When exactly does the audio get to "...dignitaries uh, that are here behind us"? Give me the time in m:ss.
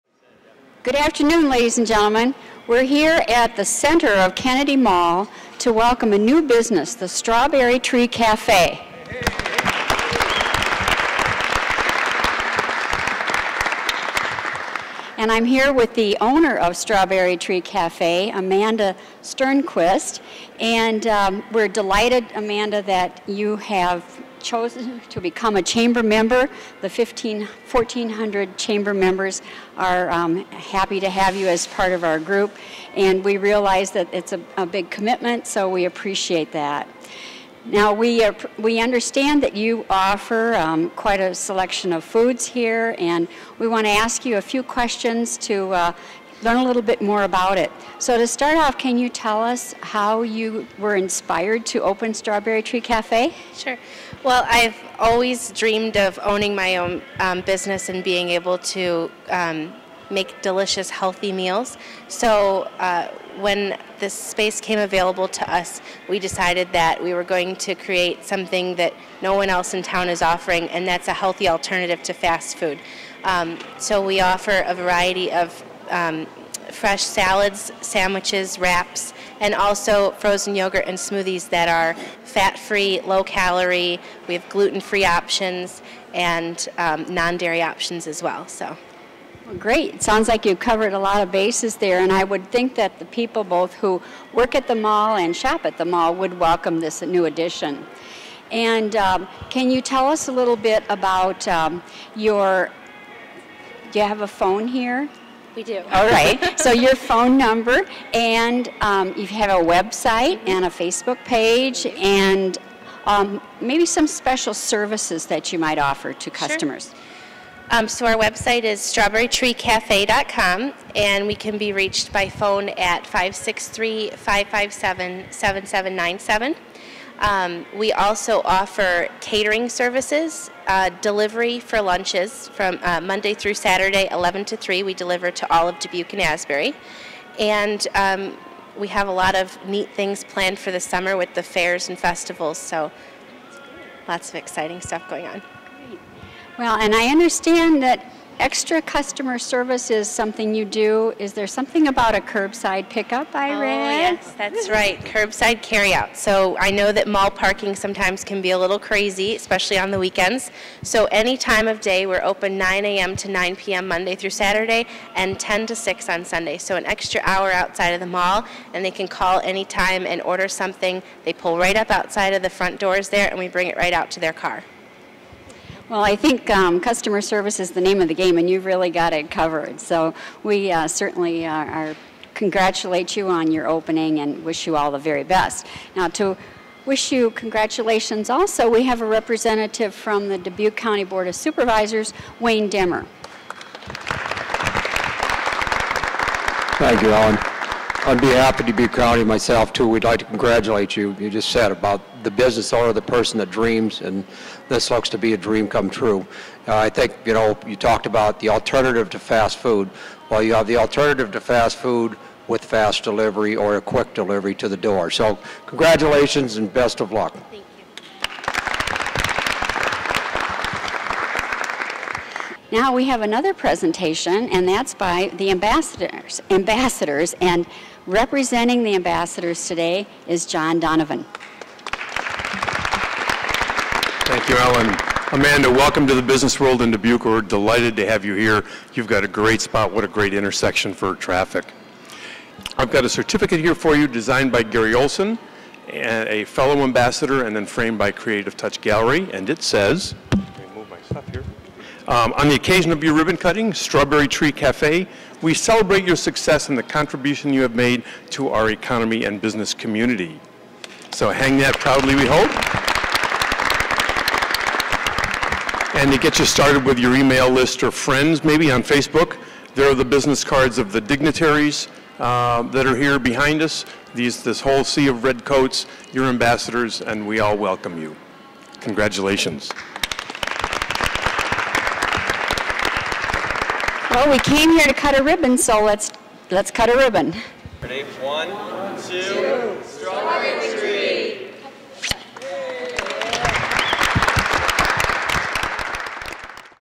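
4:30.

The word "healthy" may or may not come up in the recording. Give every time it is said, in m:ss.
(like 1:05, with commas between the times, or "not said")
1:00, 1:11.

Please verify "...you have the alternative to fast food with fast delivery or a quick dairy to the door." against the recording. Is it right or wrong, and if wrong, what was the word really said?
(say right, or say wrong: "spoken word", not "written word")
wrong: "delivery", not "dairy".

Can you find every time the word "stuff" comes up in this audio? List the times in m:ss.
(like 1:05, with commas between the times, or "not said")
2:24, 4:11.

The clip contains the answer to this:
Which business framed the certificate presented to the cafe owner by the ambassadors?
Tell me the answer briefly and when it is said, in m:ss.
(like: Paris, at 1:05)
Creative Touch Gallery, at 4:08.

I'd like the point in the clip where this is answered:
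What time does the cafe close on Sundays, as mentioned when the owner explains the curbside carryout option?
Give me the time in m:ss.
2:45.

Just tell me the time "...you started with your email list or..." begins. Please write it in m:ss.
4:26.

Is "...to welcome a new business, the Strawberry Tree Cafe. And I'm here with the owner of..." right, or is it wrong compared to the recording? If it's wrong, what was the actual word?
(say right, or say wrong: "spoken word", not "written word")
right.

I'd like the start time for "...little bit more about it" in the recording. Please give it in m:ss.
0:46.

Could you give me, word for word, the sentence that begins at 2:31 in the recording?
Is there something about a curbside pickup I oh, read?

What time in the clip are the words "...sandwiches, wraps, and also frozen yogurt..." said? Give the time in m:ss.
1:17.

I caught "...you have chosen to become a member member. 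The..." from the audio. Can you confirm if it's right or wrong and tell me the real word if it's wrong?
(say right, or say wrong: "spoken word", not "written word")
wrong: "chamber", not "member".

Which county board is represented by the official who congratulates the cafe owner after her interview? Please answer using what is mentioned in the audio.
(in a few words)
Dubuque County Board of Supervisors.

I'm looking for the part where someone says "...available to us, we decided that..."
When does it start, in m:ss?
1:04.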